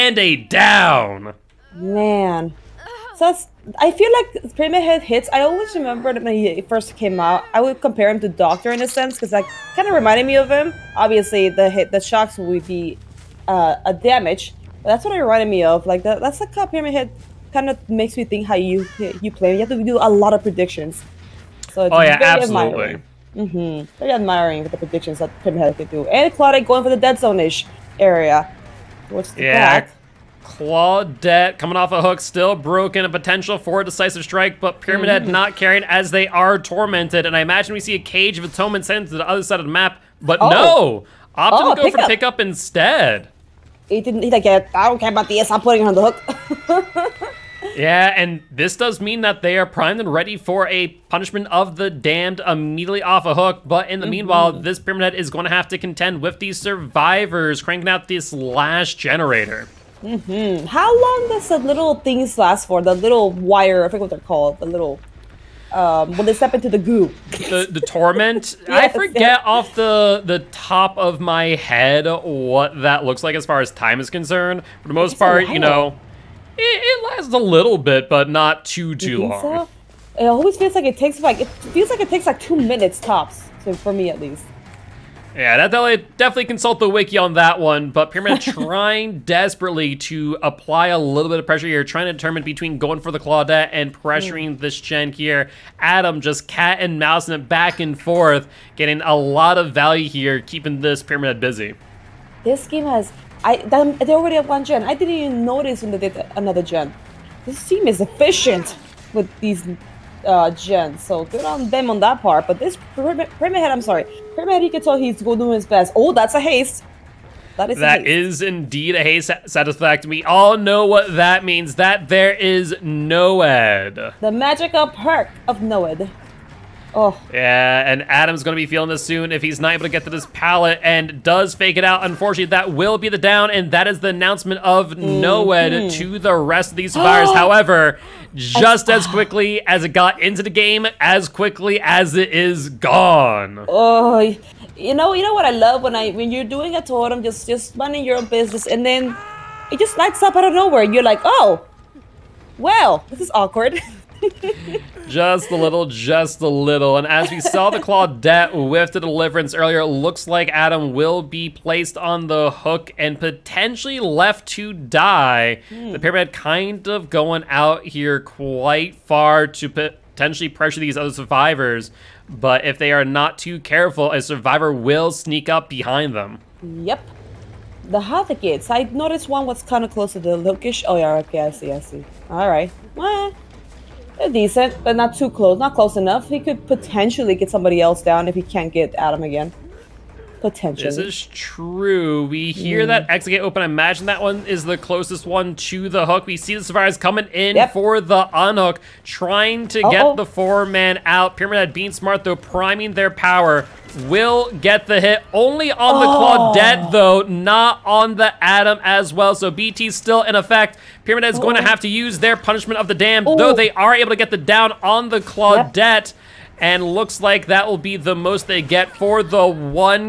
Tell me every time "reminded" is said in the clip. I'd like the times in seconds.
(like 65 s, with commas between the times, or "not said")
9 s, 15 s.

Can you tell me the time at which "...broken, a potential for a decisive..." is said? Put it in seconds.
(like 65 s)
32 s.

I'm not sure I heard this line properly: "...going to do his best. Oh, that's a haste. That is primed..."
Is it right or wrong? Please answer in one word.
wrong.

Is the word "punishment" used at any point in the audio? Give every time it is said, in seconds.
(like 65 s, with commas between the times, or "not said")
51 s, 212 s.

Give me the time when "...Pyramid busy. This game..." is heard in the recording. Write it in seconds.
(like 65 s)
101 s.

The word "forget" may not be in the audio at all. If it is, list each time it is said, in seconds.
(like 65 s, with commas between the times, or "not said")
63 s, 68 s.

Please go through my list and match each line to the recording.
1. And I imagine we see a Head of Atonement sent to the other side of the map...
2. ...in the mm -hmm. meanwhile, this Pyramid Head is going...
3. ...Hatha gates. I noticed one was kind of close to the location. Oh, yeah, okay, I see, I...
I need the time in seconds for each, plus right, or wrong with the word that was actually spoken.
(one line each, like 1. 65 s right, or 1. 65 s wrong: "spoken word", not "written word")
1. 37 s wrong: "Cage", not "Head"
2. 53 s right
3. 177 s right.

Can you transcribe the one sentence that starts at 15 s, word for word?
Like that, that's like how Pyramid Head kind of makes me think how you you play.